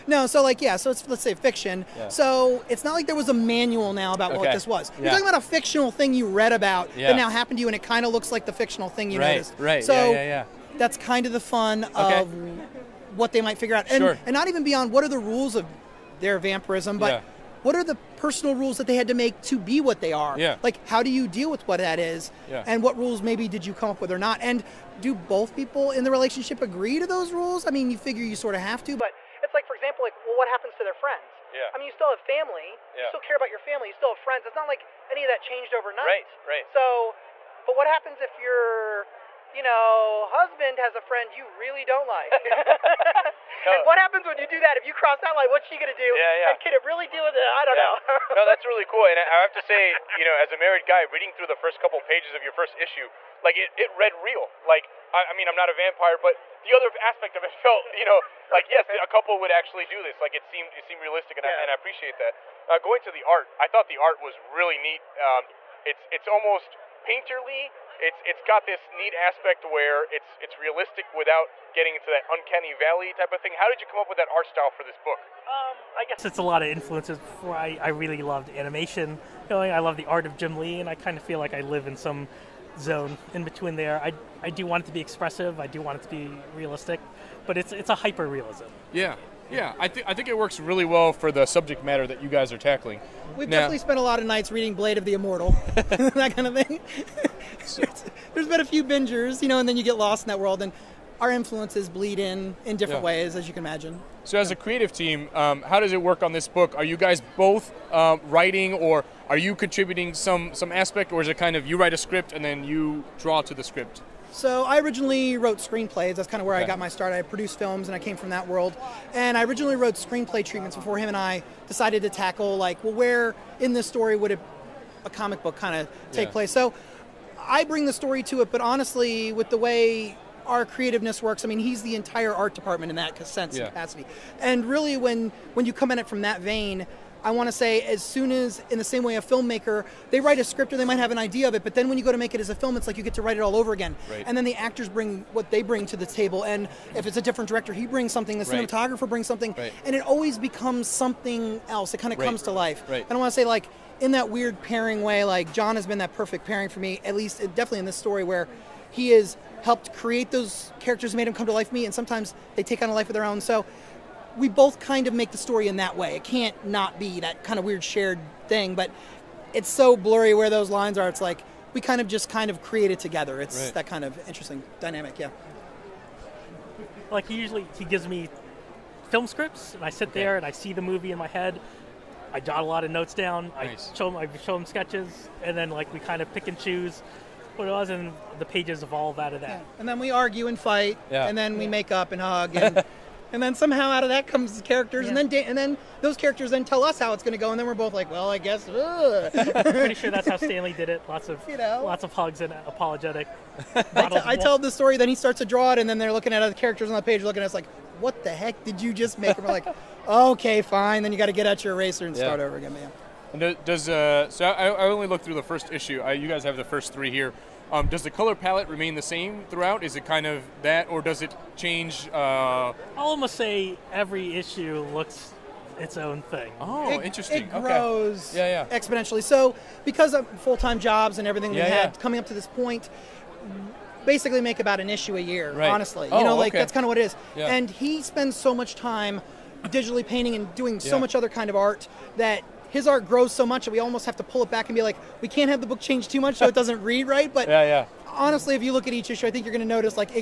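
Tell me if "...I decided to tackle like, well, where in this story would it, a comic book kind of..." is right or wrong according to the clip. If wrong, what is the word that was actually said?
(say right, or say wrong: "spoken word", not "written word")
right.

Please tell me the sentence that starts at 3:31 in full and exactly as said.
Then you got to get out your eraser and yeah.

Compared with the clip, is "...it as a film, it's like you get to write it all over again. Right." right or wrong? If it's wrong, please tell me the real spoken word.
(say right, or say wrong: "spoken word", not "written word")
right.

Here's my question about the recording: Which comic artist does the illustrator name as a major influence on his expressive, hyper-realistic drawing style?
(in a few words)
Jim Lee.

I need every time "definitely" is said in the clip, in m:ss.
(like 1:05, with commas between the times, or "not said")
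1:33, 2:37.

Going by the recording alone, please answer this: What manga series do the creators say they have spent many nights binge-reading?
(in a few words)
Blade of the Immortal.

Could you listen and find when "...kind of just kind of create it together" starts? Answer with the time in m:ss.
2:51.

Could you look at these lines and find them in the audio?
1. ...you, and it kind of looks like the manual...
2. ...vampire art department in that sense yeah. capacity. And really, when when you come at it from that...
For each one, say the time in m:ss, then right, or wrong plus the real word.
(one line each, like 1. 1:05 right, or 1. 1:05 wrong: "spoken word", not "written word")
1. 0:07 wrong: "fictional", not "manual"
2. 2:11 wrong: "entire", not "vampire".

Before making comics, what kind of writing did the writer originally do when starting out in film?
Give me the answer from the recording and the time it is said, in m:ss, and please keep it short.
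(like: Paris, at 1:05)
Screenplays, at 1:55.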